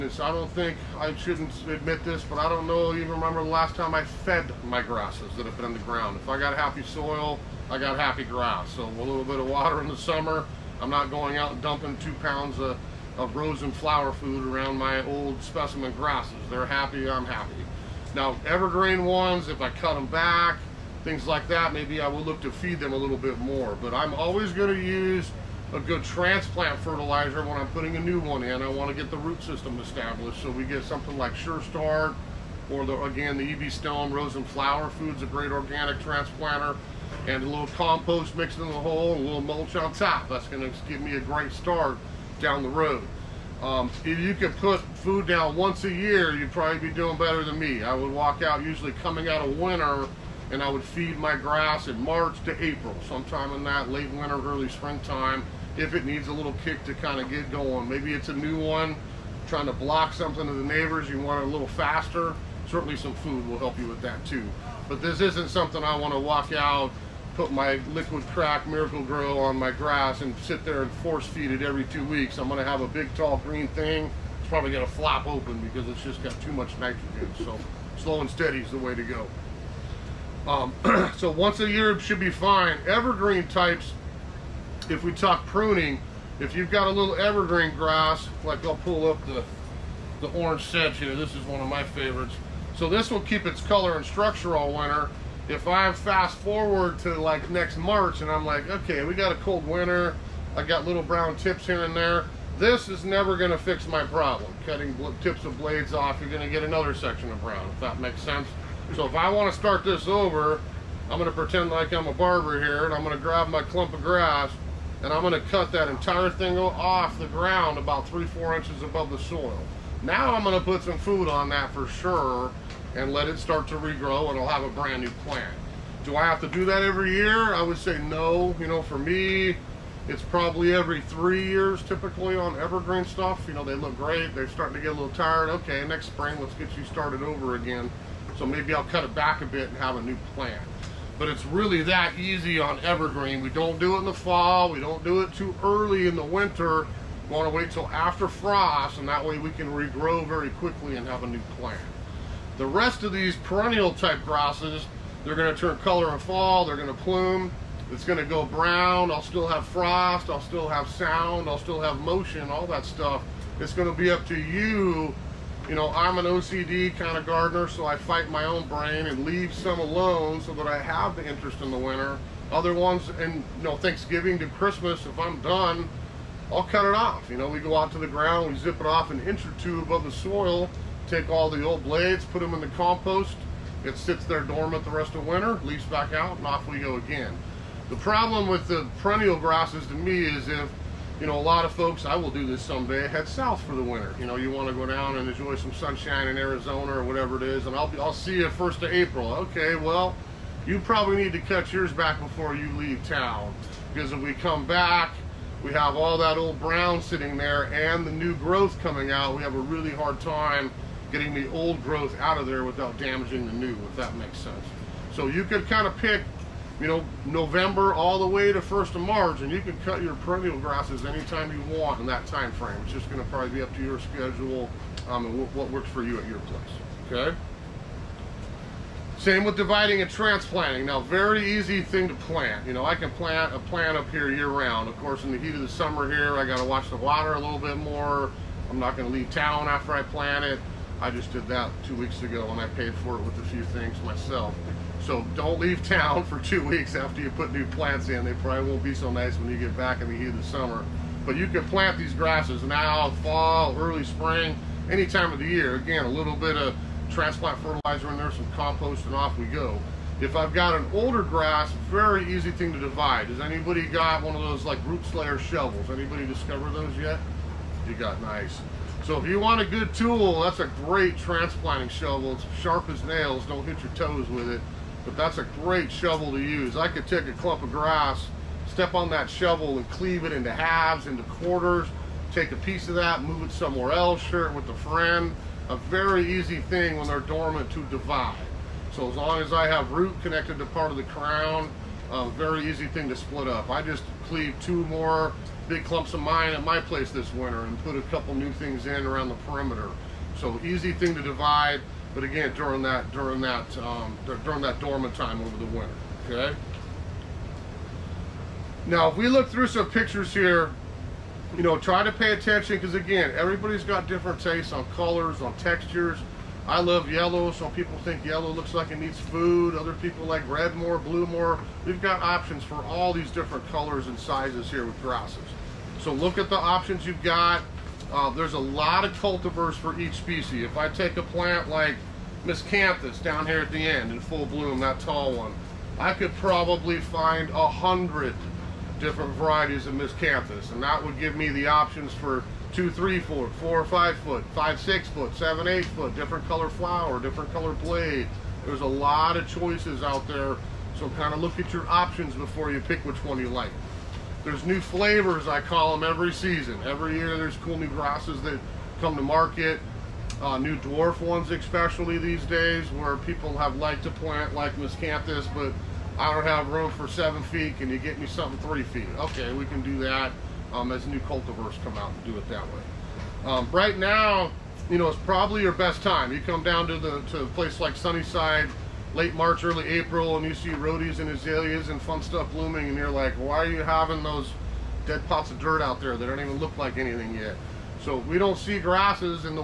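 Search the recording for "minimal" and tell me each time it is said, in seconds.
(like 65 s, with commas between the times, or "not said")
not said.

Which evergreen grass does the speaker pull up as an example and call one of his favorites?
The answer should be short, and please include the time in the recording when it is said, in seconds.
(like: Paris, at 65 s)
orange sedge, at 90 s.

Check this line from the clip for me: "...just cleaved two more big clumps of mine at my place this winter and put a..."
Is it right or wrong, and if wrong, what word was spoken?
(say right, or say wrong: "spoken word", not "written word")
right.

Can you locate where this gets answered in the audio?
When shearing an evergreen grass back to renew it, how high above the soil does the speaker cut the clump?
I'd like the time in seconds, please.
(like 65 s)
118 s.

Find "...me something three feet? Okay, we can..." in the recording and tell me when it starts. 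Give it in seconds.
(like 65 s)
368 s.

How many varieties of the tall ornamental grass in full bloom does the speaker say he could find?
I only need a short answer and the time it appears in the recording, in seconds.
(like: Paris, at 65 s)
100, at 337 s.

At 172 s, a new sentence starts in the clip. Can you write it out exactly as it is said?
Other ones, and you know, Thanksgiving to Christmas, if I'm done, I'll cut it off.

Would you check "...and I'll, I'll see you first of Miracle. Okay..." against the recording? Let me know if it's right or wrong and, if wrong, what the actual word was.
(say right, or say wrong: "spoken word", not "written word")
wrong: "April", not "Miracle".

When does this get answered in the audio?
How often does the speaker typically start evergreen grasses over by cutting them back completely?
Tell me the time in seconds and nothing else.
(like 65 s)
130 s.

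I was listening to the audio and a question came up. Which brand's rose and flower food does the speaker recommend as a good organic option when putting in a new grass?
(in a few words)
EB Stone.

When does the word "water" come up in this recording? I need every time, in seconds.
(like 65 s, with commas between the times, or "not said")
9 s, 236 s.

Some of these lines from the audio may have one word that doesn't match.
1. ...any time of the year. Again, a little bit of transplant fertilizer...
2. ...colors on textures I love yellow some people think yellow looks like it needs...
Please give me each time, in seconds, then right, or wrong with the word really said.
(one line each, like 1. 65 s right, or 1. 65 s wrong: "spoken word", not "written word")
1. 254 s right
2. 314 s right.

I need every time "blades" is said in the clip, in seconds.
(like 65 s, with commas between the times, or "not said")
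105 s, 181 s, 347 s.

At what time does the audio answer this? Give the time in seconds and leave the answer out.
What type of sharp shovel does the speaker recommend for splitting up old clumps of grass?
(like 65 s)
264 s.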